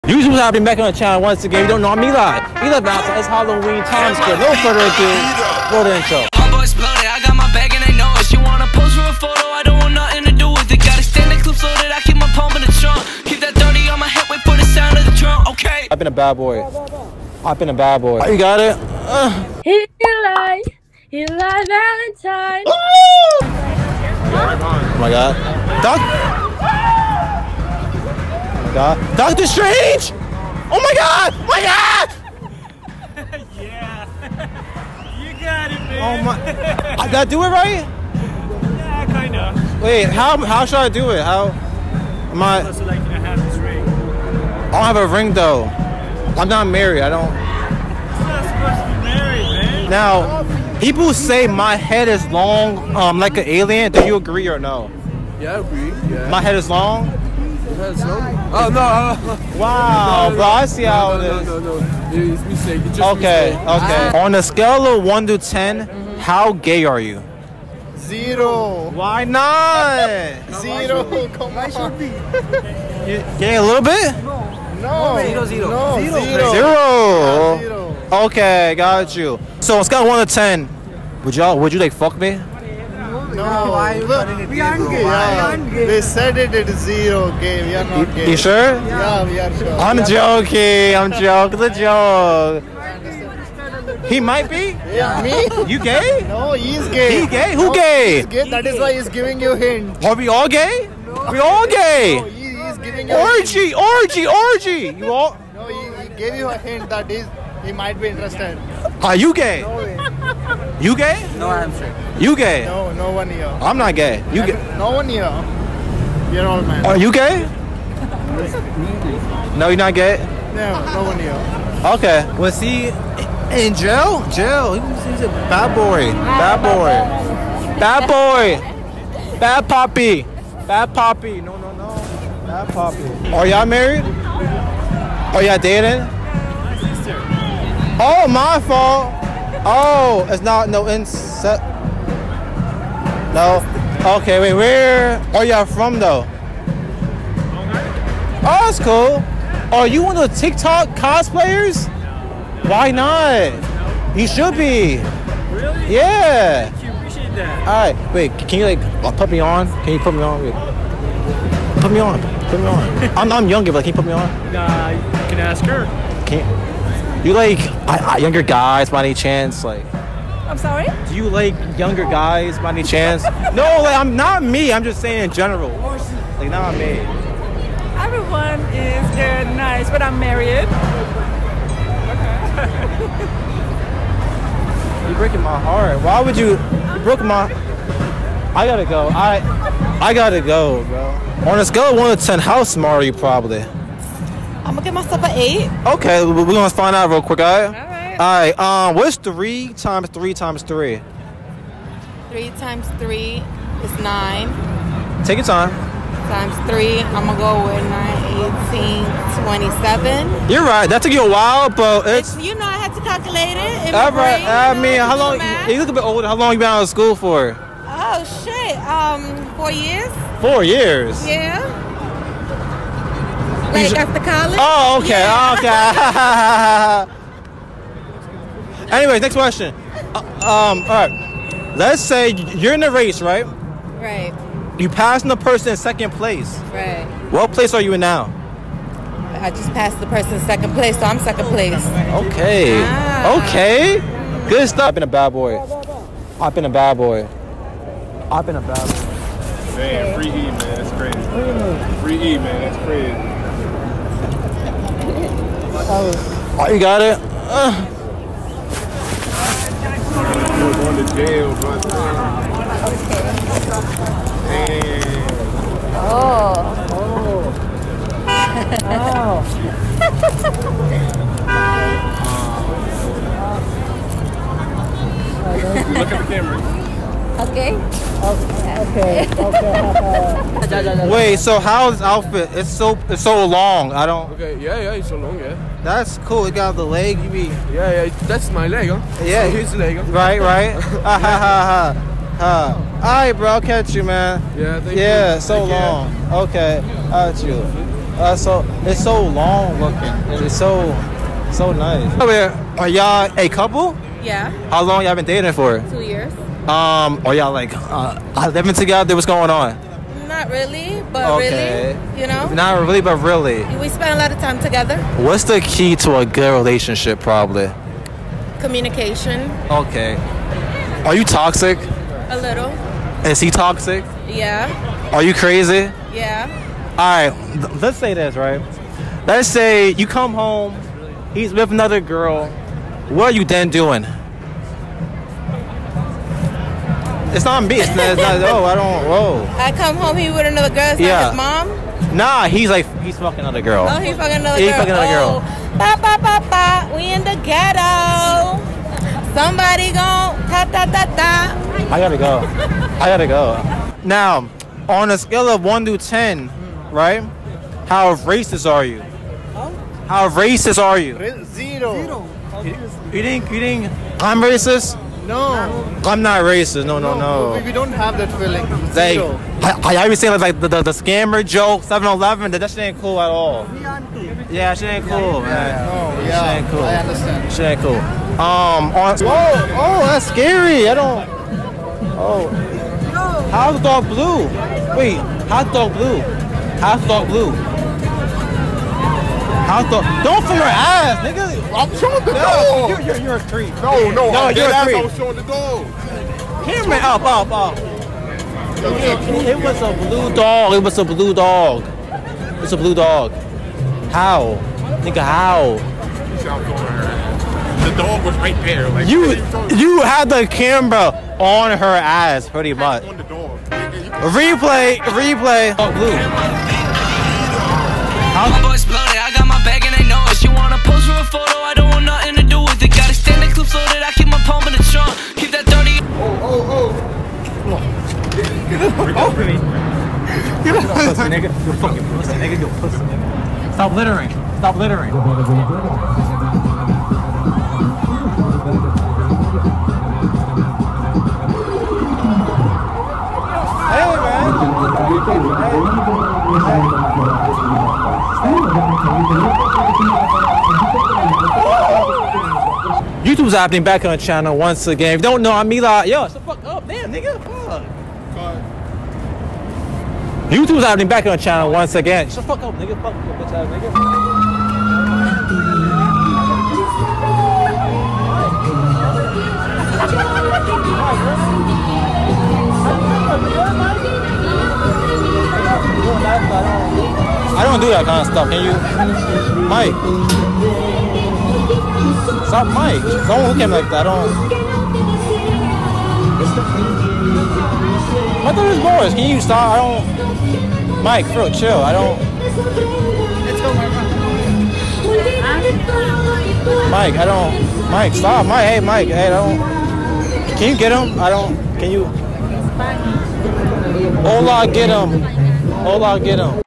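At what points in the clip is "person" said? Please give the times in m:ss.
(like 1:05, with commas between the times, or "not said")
3:55, 4:00.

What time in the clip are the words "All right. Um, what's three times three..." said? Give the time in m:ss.
3:18.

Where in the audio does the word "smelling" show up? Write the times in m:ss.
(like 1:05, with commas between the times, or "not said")
not said.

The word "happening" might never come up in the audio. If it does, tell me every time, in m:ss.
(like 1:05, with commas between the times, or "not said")
7:33, 7:40.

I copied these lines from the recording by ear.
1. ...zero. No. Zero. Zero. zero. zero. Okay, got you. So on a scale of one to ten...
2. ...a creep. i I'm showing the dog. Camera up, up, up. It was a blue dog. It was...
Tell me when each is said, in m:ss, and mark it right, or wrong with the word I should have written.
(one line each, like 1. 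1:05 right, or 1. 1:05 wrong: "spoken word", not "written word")
1. 1:15 right
2. 6:34 right.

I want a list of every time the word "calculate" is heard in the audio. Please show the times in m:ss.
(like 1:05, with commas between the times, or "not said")
3:33.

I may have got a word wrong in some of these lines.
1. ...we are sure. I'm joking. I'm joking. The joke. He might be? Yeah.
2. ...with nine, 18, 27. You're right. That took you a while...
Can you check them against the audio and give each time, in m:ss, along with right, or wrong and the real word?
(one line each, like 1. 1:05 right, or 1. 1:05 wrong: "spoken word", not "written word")
1. 1:29 right
2. 3:27 right.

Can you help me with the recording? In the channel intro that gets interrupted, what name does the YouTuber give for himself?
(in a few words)
Mila.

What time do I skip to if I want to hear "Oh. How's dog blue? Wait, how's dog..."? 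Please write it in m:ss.
6:22.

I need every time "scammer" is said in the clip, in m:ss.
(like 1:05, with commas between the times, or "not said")
6:10.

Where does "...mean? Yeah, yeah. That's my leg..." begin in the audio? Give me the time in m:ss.
4:47.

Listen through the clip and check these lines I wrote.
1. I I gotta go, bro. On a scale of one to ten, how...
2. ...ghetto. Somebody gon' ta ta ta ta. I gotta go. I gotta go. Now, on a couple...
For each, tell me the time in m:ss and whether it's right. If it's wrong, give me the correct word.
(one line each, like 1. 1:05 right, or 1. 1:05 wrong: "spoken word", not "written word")
1. 3:09 right
2. 5:47 wrong: "scale", not "couple".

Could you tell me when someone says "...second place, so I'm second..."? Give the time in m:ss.
4:00.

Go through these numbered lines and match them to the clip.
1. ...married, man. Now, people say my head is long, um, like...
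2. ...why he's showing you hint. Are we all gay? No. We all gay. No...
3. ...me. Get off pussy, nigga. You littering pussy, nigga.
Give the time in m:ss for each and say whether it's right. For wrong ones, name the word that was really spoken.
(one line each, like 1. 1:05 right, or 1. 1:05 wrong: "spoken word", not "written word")
1. 0:49 right
2. 1:38 wrong: "giving", not "showing"
3. 7:09 wrong: "fucking", not "littering".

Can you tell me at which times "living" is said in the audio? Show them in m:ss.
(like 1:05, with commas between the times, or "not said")
5:08.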